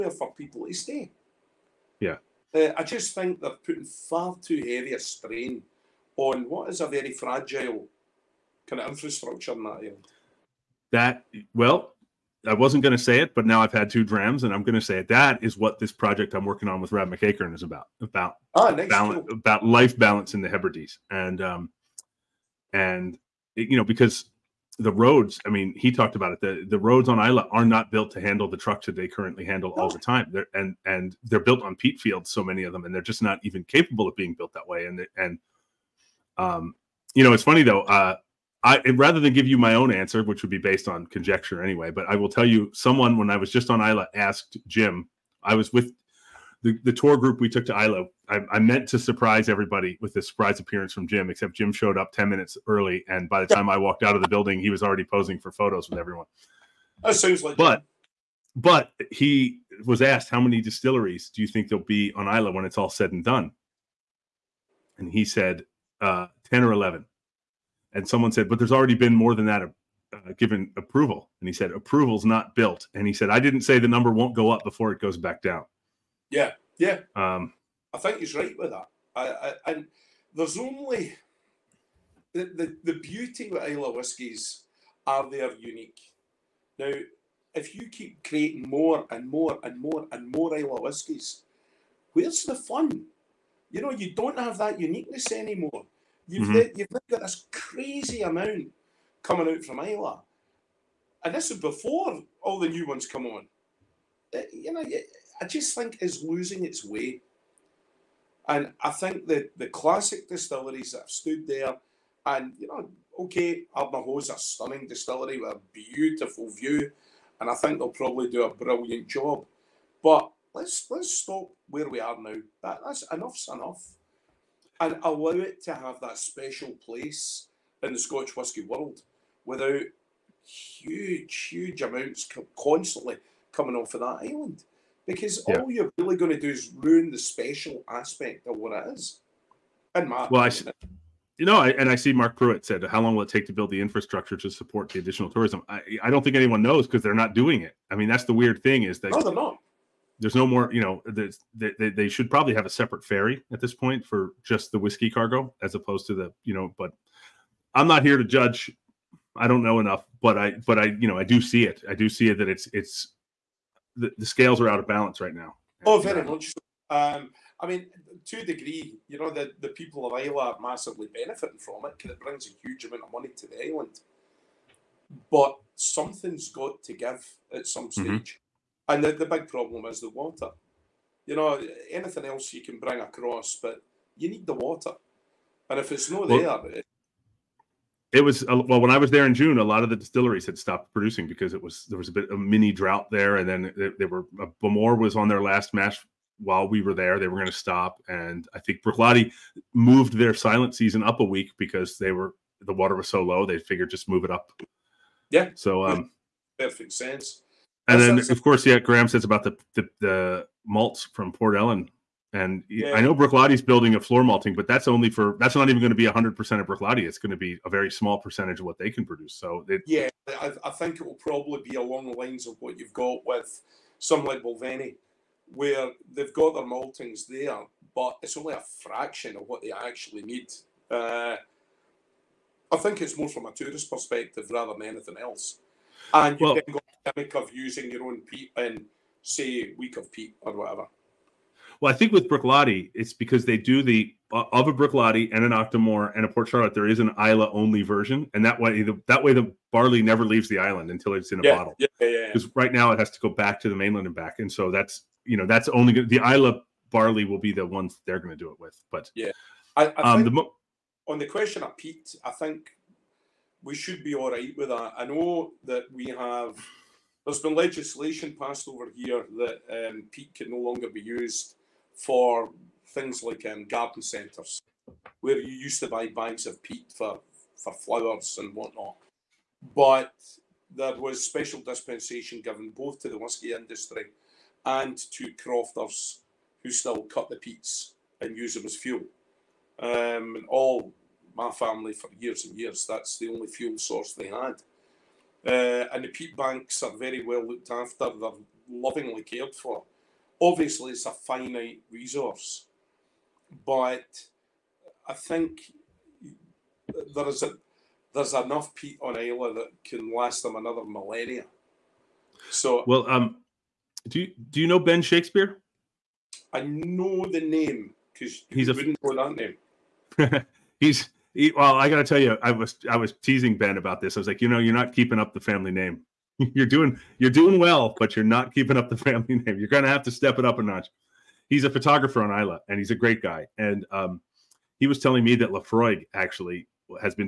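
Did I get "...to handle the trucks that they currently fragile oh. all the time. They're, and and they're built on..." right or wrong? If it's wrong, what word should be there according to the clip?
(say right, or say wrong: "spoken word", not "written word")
wrong: "handle", not "fragile".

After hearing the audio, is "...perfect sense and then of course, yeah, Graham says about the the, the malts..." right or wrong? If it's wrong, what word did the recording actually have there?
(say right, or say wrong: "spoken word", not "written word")
right.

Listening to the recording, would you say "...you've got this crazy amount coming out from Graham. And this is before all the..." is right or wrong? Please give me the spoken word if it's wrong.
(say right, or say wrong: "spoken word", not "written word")
wrong: "Iowa", not "Graham".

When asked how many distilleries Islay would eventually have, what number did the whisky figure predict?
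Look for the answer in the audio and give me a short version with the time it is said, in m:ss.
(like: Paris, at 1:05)
10 or 11, at 1:06.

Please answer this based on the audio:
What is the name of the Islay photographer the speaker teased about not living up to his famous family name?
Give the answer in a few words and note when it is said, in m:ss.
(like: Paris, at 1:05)
Ben Shakespeare, at 5:14.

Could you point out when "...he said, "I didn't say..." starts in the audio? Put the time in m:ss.
1:13.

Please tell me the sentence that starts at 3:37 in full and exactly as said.
It's going to be a very small percentage of what they can produce.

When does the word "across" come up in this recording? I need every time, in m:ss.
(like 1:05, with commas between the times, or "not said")
3:02.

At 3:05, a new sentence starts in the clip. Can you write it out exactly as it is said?
And if it's not well, there, it, it was uh, well when I was there in June.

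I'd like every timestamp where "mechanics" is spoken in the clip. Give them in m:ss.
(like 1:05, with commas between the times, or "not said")
not said.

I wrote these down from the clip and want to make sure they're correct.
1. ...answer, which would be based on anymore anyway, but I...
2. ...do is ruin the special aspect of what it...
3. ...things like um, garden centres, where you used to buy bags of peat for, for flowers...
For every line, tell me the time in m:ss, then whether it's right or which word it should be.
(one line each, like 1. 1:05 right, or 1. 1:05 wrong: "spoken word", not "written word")
1. 0:39 wrong: "conjecture", not "anymore"
2. 2:16 right
3. 4:32 right.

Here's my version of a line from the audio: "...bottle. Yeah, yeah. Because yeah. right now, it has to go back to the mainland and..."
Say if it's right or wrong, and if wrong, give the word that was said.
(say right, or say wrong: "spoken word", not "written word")
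right.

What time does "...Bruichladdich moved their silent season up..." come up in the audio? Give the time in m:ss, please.
3:18.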